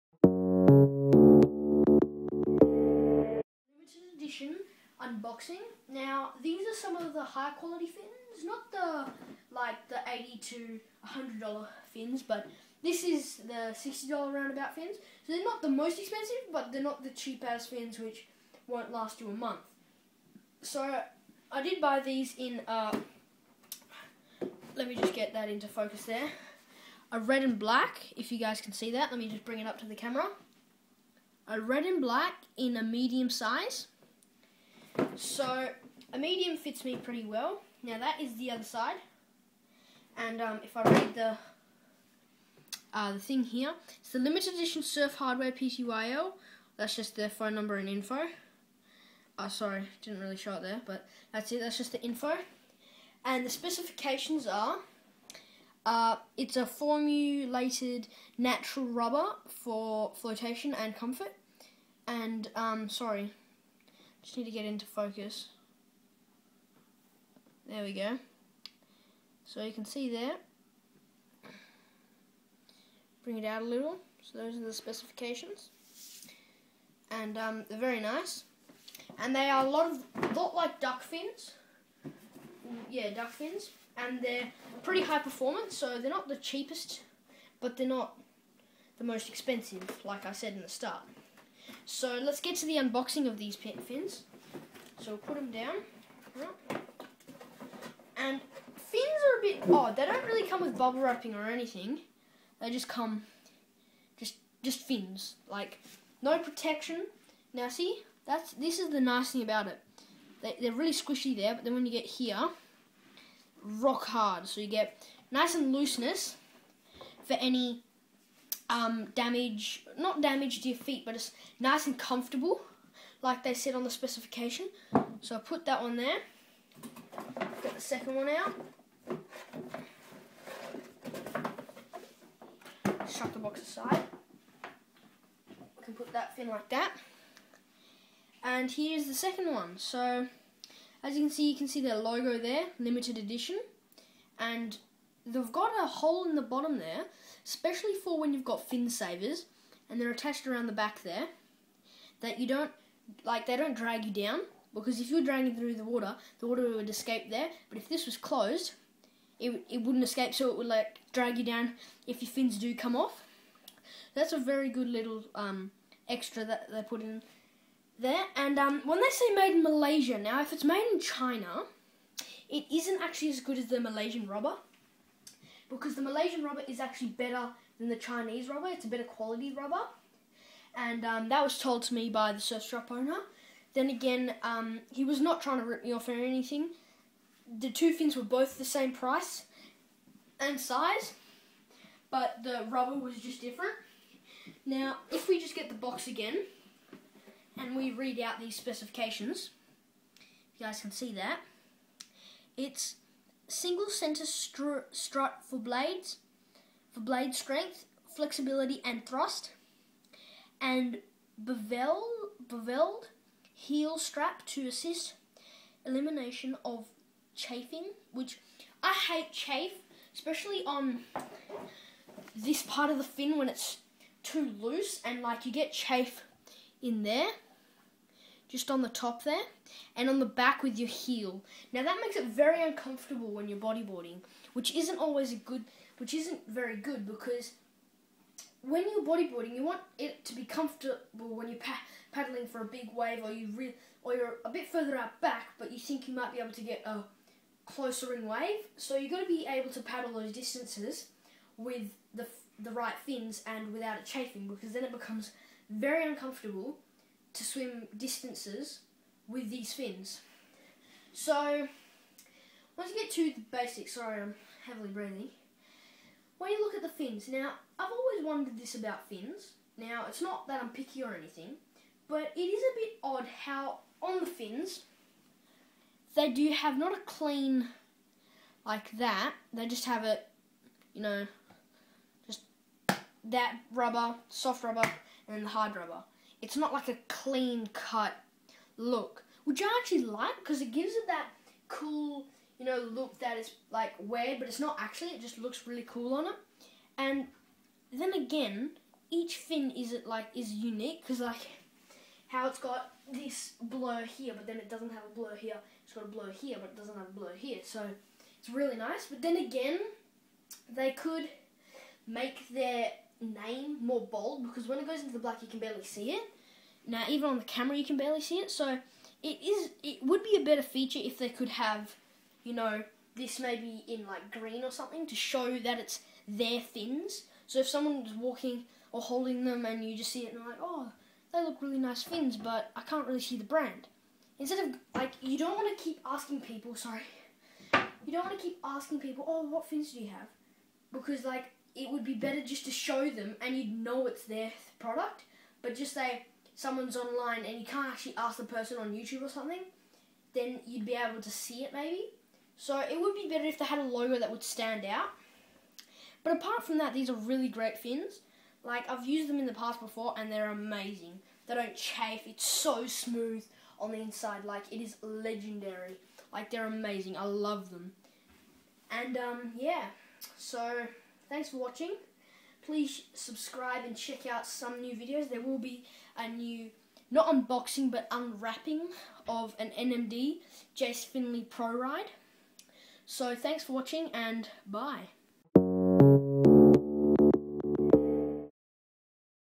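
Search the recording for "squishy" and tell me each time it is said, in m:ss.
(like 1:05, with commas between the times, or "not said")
1:50.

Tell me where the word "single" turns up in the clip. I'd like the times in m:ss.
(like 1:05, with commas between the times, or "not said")
3:23.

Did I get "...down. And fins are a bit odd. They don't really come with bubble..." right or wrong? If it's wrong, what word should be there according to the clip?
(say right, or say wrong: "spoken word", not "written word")
right.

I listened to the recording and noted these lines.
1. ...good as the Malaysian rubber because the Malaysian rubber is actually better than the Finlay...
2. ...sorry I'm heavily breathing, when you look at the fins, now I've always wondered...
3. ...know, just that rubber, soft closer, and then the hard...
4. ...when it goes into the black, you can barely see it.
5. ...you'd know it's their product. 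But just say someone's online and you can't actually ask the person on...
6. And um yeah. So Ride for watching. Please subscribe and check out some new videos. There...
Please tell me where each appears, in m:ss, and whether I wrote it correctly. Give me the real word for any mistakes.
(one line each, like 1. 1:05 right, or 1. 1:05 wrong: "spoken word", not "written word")
1. 2:53 wrong: "Chinese", not "Finlay"
2. 4:23 right
3. 4:41 wrong: "rubber", not "closer"
4. 5:14 right
5. 5:43 right
6. 6:08 wrong: "Thanks", not "Ride".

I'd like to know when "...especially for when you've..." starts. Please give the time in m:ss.
2:27.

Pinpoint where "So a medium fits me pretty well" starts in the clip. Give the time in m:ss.
0:35.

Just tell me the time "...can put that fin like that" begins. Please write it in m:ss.
2:15.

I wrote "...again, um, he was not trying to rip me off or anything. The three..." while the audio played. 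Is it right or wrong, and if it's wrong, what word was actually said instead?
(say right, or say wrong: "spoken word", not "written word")
wrong: "two", not "three".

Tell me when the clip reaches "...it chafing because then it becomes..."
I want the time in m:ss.
4:13.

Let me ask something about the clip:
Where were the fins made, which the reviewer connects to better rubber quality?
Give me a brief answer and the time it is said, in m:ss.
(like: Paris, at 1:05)
Malaysia, at 2:49.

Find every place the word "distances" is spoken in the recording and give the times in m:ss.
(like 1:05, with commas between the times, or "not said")
4:10, 4:17.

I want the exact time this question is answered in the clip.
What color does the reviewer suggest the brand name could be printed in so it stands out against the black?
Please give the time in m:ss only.
5:24.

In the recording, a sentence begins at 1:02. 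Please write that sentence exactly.
And, um, sorry, just need to get into focus.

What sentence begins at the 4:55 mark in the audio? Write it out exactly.
It just looks really cool on it.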